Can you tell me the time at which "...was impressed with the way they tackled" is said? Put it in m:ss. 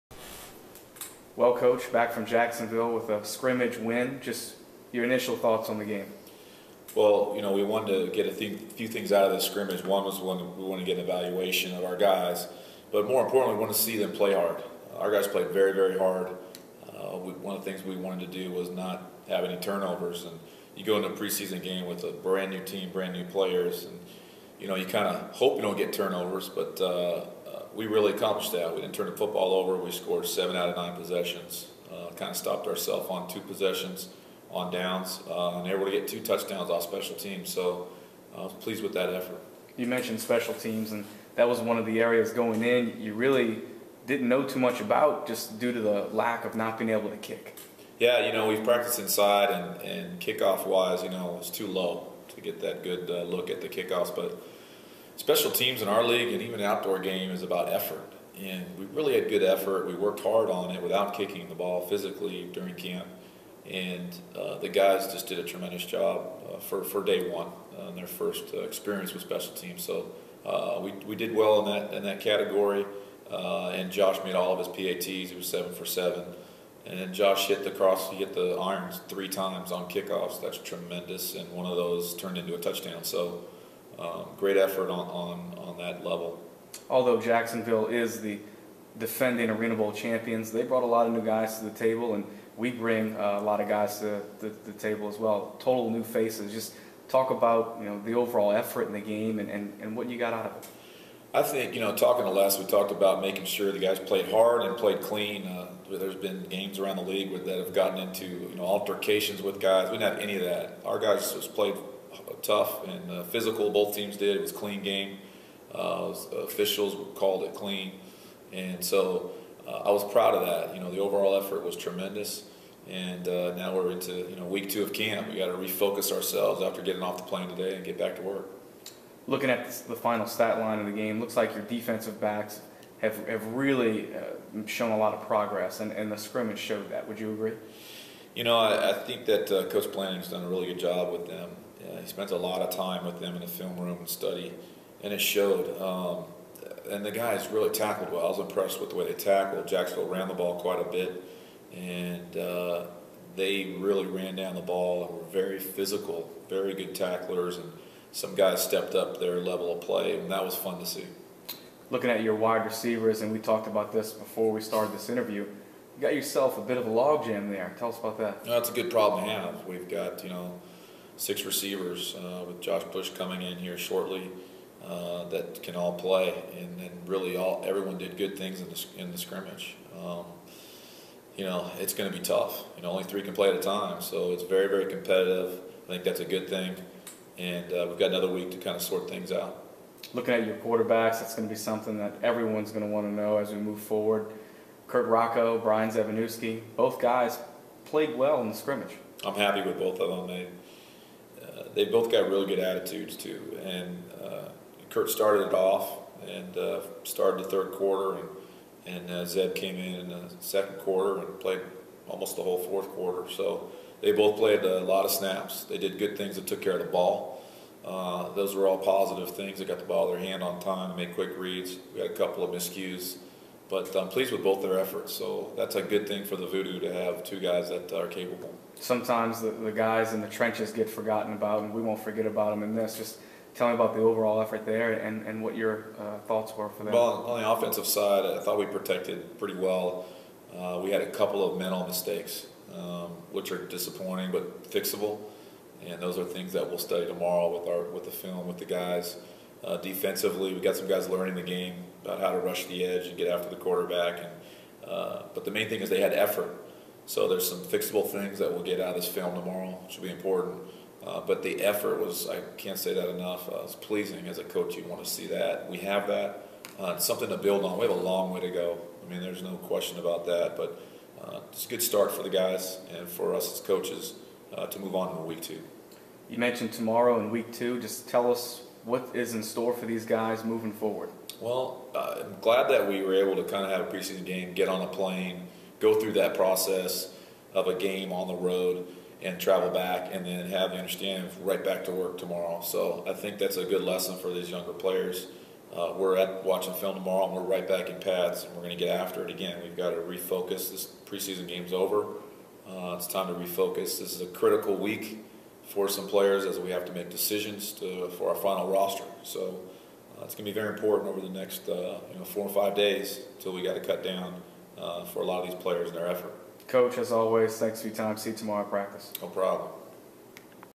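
2:28.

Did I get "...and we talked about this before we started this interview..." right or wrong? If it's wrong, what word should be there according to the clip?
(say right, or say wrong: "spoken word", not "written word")
right.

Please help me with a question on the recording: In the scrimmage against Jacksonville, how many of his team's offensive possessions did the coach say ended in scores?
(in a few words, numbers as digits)
7 out of 9.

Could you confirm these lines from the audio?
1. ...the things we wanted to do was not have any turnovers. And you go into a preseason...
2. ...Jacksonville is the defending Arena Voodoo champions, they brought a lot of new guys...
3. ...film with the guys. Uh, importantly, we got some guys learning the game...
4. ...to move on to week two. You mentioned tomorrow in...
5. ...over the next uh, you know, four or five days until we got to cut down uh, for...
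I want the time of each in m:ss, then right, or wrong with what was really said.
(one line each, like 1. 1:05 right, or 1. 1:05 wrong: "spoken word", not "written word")
1. 0:17 right
2. 1:27 wrong: "Bowl", not "Voodoo"
3. 4:08 wrong: "defensively", not "importantly"
4. 4:34 right
5. 5:11 right.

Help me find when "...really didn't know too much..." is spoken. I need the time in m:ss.
0:43.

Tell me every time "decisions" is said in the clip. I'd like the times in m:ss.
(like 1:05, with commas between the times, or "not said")
5:07.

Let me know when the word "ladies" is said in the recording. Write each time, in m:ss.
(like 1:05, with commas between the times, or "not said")
not said.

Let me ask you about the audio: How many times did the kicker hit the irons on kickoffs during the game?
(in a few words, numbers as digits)
3 times.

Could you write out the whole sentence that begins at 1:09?
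So uh, we, we did well in that, in that category.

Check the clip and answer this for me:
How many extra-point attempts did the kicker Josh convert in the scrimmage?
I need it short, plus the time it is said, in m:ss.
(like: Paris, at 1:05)
7 for 7, at 1:15.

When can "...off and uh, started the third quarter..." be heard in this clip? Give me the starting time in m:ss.
3:25.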